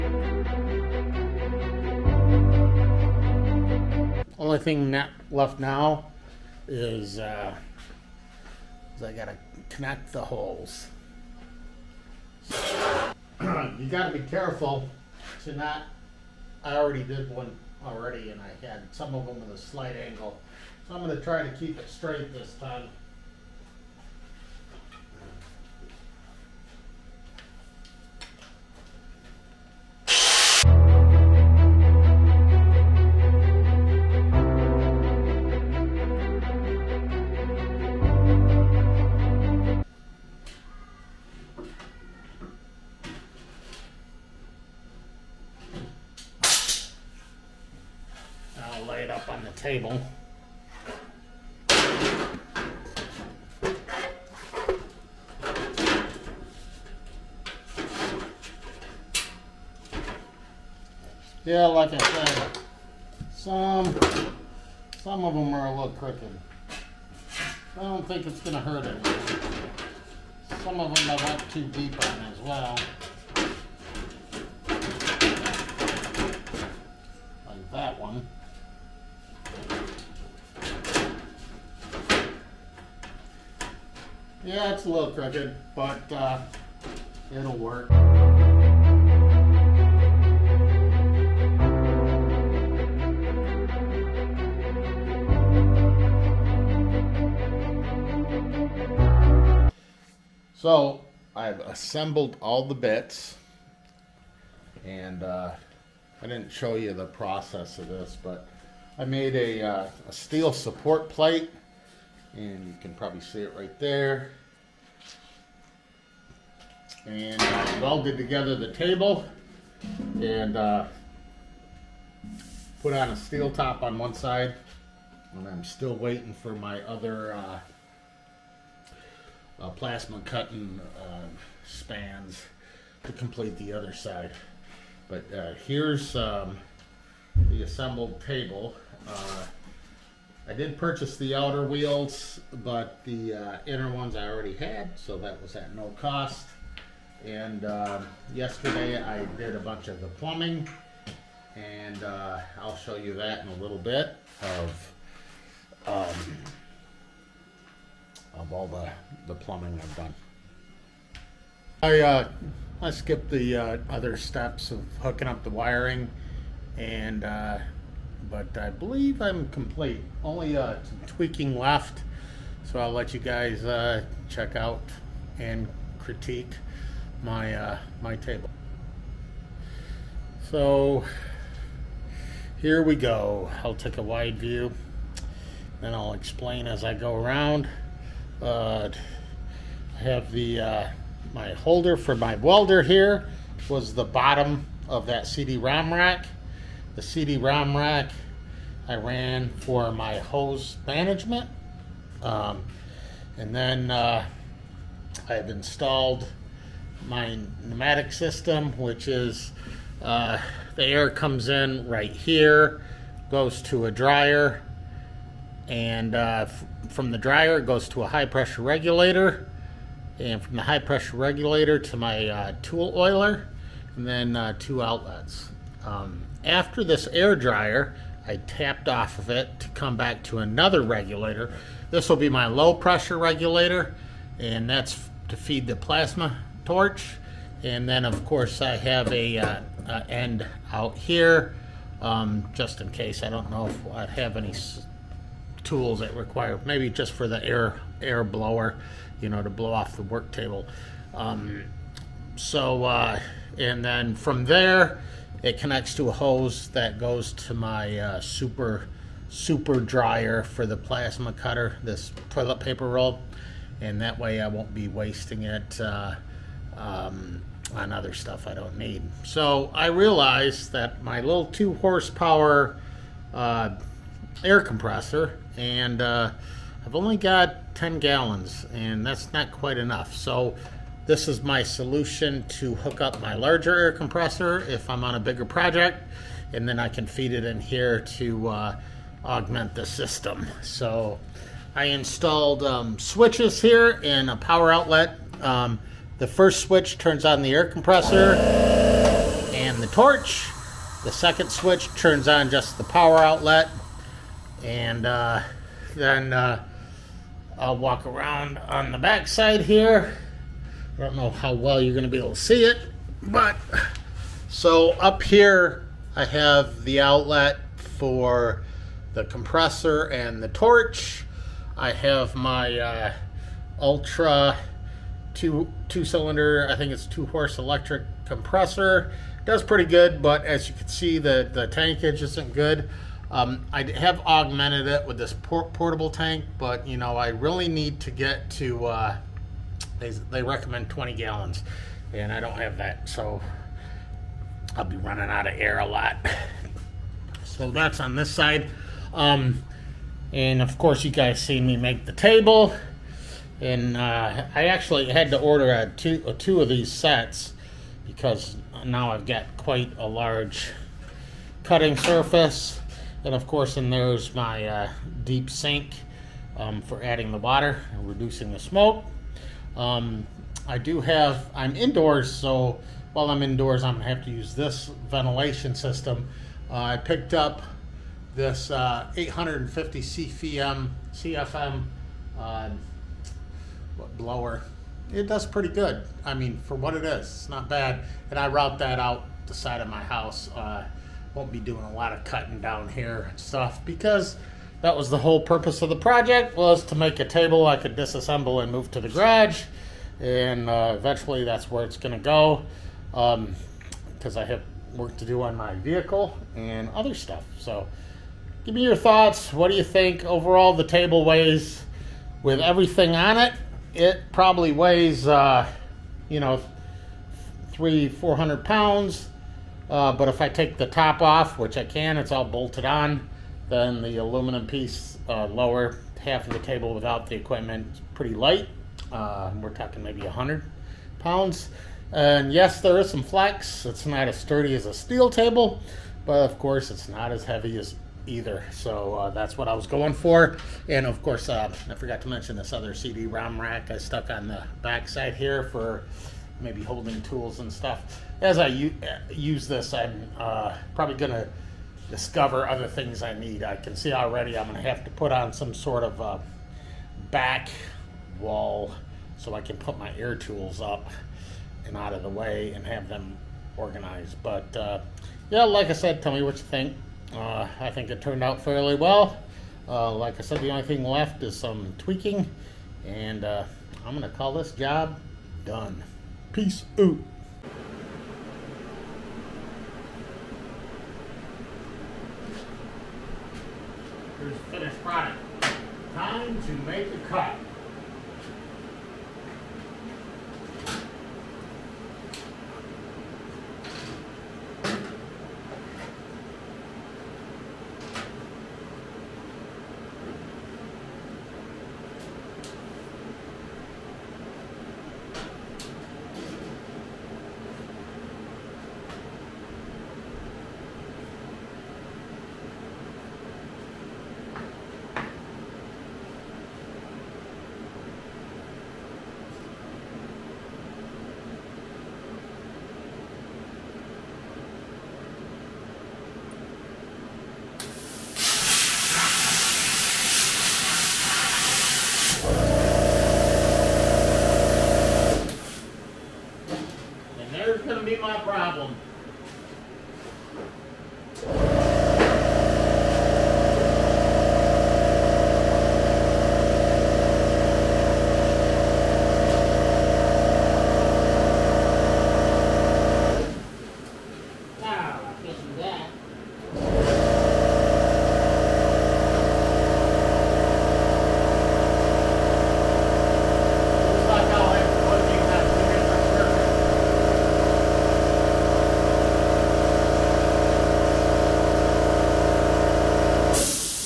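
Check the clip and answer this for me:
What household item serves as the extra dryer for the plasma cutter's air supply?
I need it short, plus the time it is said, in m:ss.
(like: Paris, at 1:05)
Toilet paper roll, at 4:22.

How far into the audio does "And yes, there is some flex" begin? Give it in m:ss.
7:12.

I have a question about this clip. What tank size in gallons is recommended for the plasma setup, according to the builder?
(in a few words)
20.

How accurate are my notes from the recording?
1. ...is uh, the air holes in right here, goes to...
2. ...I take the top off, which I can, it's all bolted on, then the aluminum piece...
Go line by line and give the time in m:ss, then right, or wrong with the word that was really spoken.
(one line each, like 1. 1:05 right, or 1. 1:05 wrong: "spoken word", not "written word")
1. 3:29 wrong: "comes", not "holes"
2. 7:00 right.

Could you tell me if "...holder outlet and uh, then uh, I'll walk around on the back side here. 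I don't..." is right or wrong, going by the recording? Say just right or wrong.
wrong.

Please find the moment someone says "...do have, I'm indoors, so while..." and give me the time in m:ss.
6:10.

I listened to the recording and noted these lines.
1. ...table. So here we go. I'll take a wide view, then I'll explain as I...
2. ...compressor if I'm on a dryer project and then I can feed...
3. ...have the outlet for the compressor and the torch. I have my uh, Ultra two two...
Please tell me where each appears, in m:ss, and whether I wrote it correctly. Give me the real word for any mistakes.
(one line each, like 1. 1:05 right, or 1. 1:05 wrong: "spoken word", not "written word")
1. 2:58 right
2. 4:43 wrong: "bigger", not "dryer"
3. 5:16 right.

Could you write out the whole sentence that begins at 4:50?
So I installed um, switches here and a power outlet.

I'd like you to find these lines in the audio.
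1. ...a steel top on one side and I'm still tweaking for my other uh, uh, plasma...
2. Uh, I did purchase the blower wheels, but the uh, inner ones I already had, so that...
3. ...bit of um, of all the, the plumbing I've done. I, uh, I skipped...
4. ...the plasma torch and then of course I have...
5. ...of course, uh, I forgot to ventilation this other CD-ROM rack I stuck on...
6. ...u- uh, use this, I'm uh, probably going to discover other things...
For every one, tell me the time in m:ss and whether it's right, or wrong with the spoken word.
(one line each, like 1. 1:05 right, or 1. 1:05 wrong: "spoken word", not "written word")
1. 2:03 wrong: "waiting", not "tweaking"
2. 2:19 wrong: "outer", not "blower"
3. 2:33 right
4. 3:55 right
5. 7:21 wrong: "mention", not "ventilation"
6. 7:28 right.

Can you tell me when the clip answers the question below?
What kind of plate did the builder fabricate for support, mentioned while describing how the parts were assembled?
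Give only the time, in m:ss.
1:50.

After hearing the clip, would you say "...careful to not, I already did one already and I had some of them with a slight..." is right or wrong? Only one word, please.
right.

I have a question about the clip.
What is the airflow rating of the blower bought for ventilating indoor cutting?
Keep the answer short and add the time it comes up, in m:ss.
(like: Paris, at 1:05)
850 CFM, at 6:19.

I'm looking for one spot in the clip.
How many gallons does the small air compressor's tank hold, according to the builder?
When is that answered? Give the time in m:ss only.
4:37.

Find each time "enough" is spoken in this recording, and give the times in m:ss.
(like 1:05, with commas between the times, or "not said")
4:39.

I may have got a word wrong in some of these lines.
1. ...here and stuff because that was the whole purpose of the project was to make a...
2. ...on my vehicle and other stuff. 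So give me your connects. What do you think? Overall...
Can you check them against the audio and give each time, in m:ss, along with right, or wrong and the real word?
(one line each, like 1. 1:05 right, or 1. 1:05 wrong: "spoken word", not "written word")
1. 6:32 right
2. 6:45 wrong: "thoughts", not "connects".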